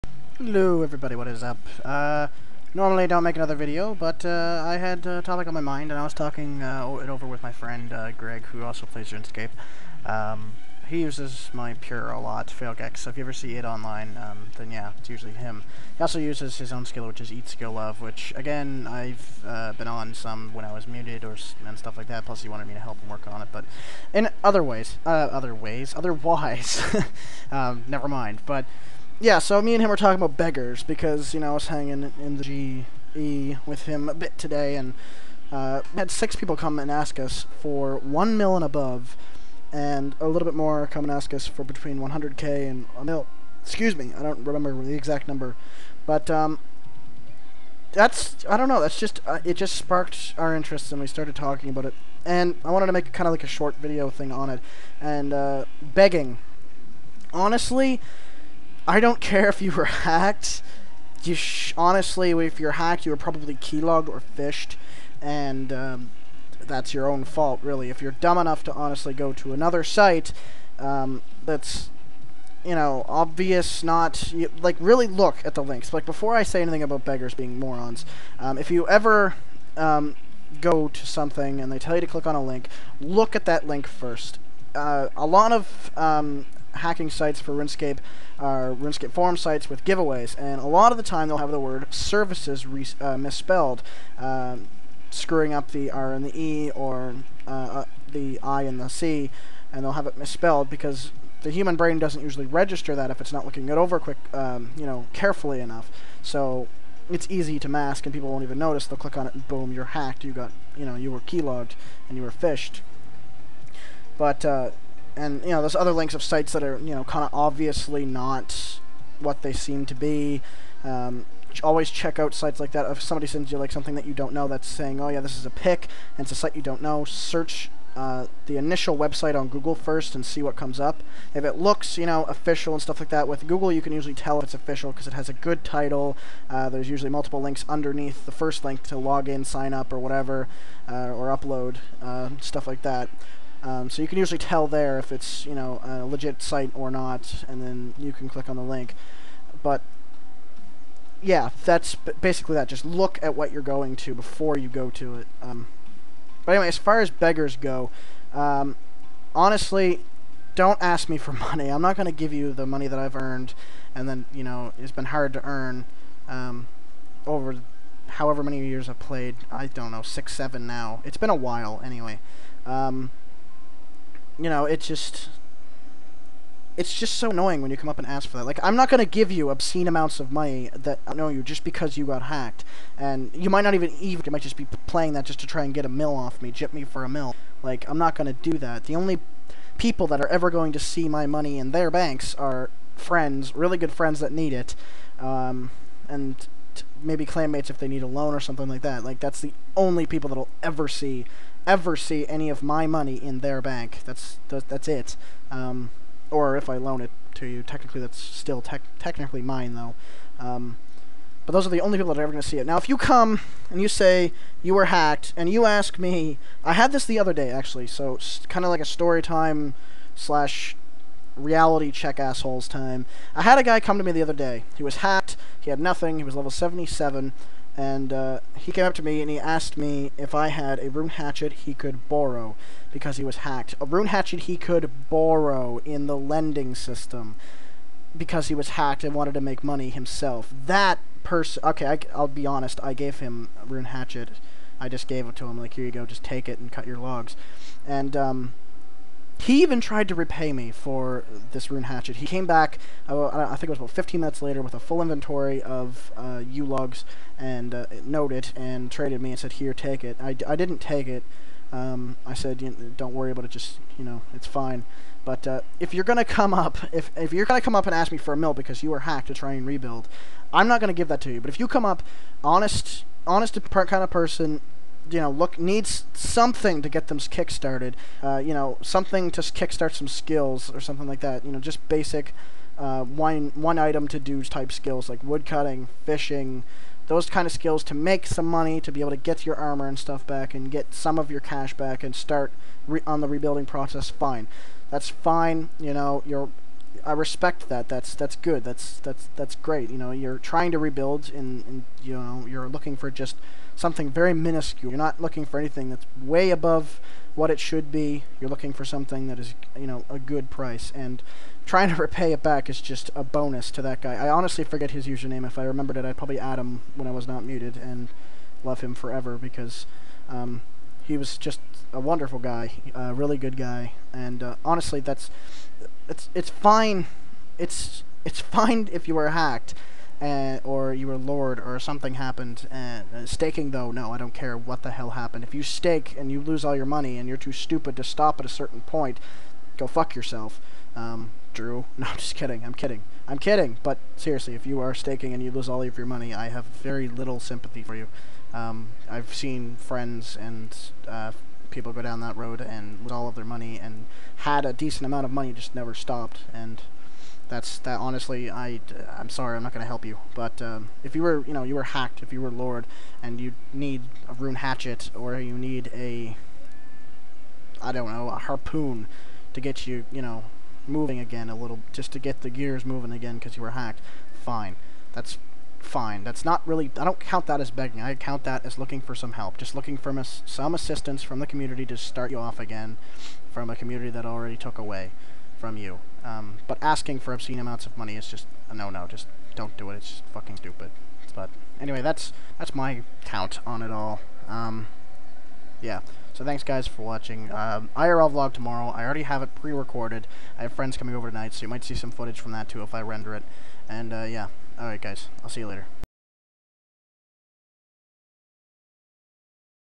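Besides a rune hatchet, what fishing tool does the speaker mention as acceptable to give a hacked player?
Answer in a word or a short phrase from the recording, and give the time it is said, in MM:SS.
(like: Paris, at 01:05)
harpoon, at 06:08.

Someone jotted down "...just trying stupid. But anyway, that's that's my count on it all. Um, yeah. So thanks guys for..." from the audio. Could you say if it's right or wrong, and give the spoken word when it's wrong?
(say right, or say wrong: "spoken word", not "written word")
wrong: "fucking", not "trying".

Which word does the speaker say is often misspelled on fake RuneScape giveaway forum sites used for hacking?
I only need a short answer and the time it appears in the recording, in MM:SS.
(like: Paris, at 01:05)
services, at 01:31.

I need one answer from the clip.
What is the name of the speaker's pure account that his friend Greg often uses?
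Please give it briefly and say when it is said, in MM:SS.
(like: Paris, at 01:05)
Failgex, at 00:12.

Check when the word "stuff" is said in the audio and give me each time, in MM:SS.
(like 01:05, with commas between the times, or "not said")
00:21, 02:12, 02:22, 04:49.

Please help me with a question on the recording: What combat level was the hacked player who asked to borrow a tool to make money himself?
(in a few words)
77.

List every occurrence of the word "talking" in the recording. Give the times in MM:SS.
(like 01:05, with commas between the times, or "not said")
00:06, 00:29, 00:51.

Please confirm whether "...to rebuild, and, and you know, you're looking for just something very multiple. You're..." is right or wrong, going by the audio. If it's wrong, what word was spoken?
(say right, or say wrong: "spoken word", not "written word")
wrong: "minuscule", not "multiple".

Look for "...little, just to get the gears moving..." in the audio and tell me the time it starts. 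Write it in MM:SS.
06:11.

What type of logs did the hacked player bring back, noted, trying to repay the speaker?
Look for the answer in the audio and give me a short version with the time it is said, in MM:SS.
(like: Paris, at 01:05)
yew logs, at 04:16.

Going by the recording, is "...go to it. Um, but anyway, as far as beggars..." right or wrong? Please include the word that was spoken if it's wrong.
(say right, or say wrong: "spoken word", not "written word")
right.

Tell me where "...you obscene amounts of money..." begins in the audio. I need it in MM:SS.
02:59.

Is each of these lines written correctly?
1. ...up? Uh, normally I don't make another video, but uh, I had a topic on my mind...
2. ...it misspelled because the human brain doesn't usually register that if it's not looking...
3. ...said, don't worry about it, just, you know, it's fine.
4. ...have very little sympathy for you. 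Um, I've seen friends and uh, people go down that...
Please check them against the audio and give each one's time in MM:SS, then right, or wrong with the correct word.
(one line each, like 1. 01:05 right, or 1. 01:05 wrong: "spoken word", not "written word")
1. 00:01 right
2. 01:40 right
3. 04:22 right
4. 05:46 right.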